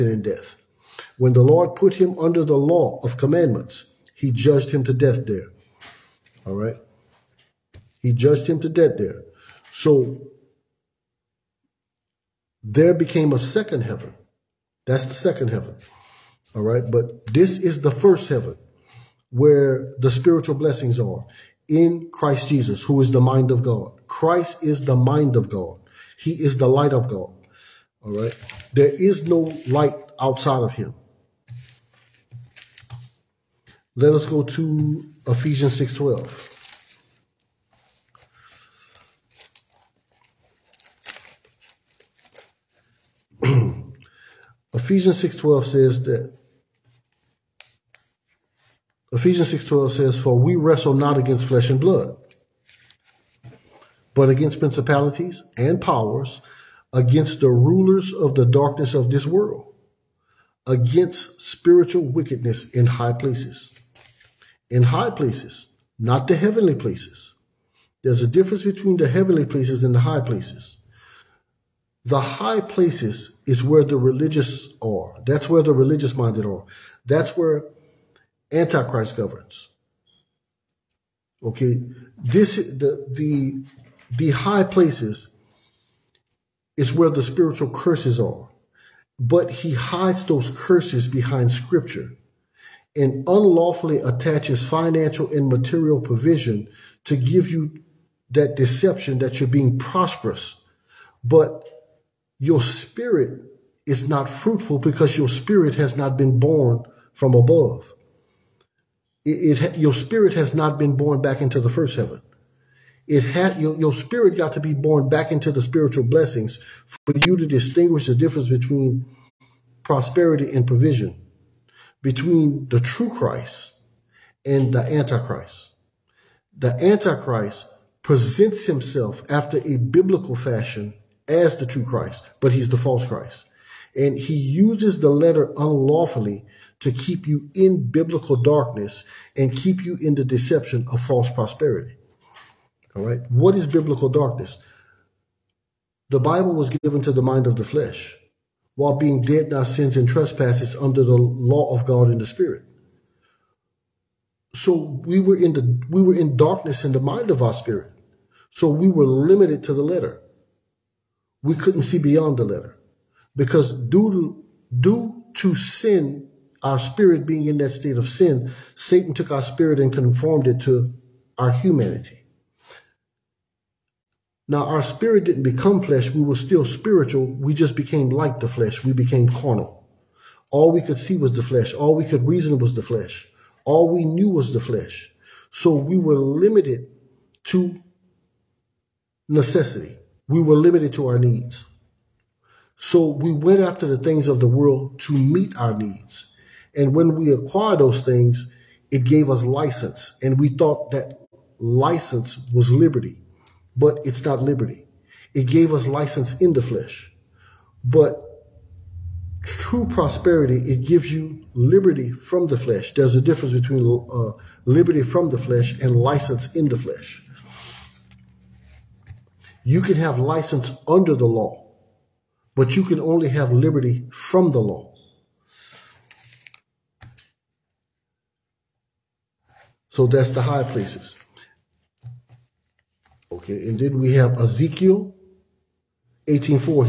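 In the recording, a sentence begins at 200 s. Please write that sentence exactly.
And we thought that license was liberty, but it's not liberty.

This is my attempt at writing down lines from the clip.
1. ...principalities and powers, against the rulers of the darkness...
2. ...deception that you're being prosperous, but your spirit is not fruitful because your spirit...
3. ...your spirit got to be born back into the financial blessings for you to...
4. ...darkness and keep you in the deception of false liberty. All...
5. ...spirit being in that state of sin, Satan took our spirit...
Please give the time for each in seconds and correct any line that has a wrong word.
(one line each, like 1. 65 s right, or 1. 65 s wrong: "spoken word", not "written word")
1. 54 s right
2. 98 s right
3. 113 s wrong: "spiritual", not "financial"
4. 138 s wrong: "prosperity", not "liberty"
5. 166 s right.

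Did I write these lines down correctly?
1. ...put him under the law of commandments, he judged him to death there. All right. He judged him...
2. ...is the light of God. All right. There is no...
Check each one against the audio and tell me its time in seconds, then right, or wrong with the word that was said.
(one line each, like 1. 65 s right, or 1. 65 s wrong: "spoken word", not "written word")
1. 1 s right
2. 26 s right.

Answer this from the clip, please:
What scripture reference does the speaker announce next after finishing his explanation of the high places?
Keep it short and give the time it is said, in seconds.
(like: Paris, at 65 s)
Ezekiel 18:4, at 234 s.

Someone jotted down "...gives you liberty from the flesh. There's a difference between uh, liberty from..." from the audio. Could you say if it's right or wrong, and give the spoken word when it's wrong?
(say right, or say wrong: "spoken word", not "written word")
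right.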